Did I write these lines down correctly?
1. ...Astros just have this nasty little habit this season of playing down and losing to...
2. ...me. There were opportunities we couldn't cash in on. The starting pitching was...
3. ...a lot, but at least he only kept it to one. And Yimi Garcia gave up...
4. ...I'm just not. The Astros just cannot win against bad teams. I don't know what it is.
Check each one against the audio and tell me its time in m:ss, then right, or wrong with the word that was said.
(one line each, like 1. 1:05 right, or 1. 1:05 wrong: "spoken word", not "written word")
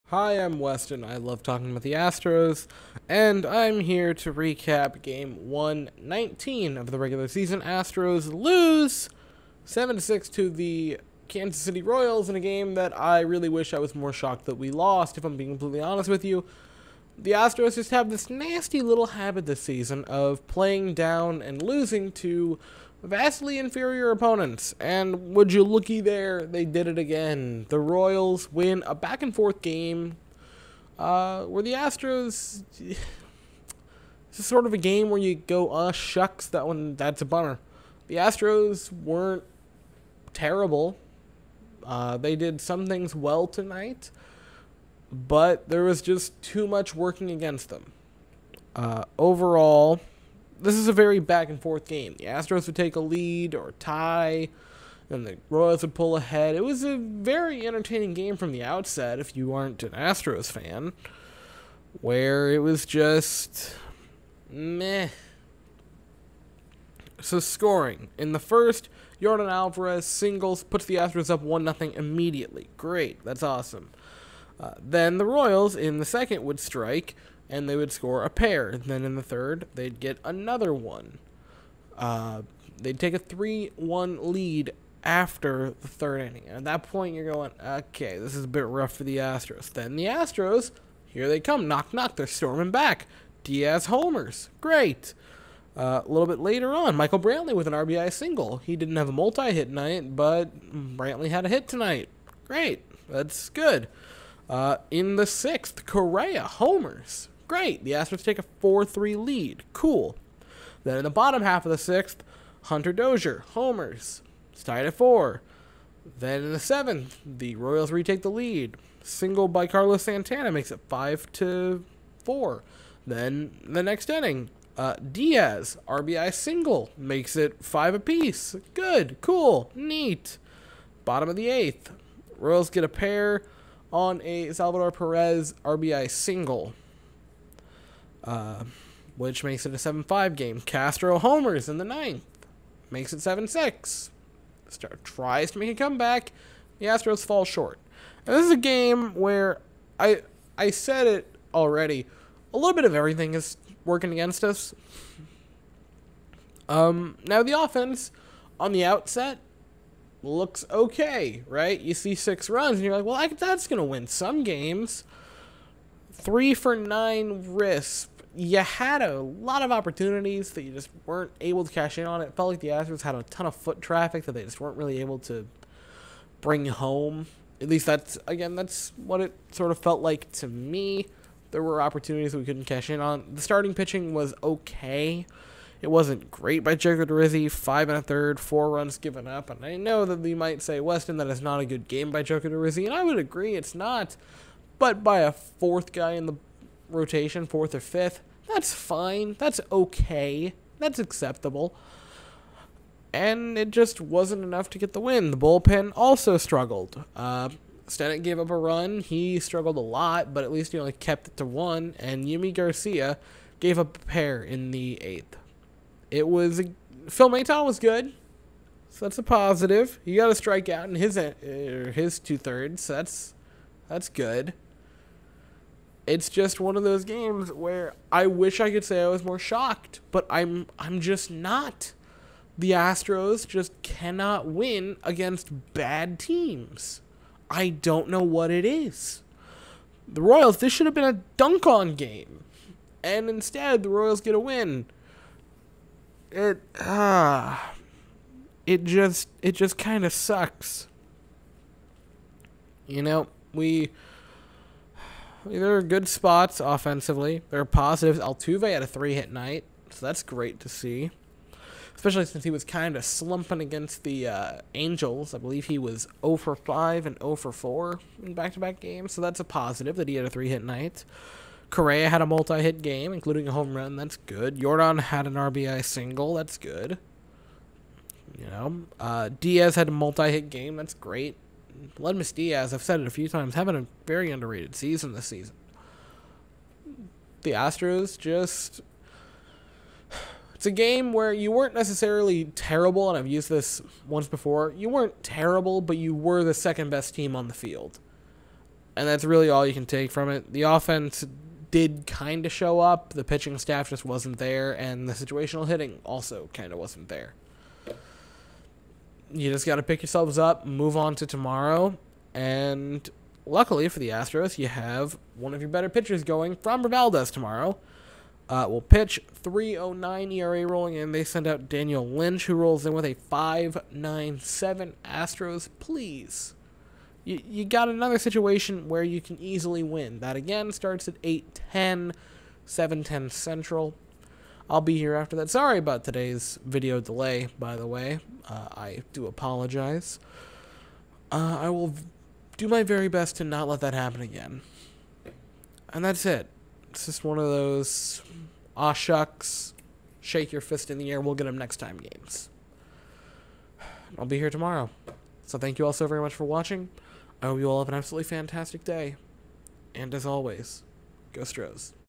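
1. 0:17 right
2. 3:00 right
3. 3:29 right
4. 3:50 right.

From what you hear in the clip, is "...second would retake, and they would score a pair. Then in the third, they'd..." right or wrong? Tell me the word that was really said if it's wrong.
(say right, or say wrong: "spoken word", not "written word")
wrong: "strike", not "retake".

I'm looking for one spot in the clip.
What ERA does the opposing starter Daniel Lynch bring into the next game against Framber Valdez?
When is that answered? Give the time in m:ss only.
5:23.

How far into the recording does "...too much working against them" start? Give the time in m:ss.
0:46.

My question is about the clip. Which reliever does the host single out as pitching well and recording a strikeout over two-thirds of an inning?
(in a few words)
Phil Maton.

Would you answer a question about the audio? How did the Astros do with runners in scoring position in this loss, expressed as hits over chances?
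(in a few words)
3 for 9.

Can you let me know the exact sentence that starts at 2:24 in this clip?
Star tries to make a comeback.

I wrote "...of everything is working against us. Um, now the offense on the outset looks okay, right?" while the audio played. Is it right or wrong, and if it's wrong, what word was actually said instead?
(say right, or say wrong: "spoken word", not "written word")
right.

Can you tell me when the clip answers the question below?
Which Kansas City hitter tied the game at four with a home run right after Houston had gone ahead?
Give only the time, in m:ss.
1:52.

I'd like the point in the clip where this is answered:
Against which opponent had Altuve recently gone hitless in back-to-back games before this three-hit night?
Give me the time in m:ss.
4:24.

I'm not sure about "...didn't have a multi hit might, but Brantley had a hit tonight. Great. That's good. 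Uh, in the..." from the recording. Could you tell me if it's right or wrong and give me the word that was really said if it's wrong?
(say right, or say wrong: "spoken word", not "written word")
wrong: "night", not "might".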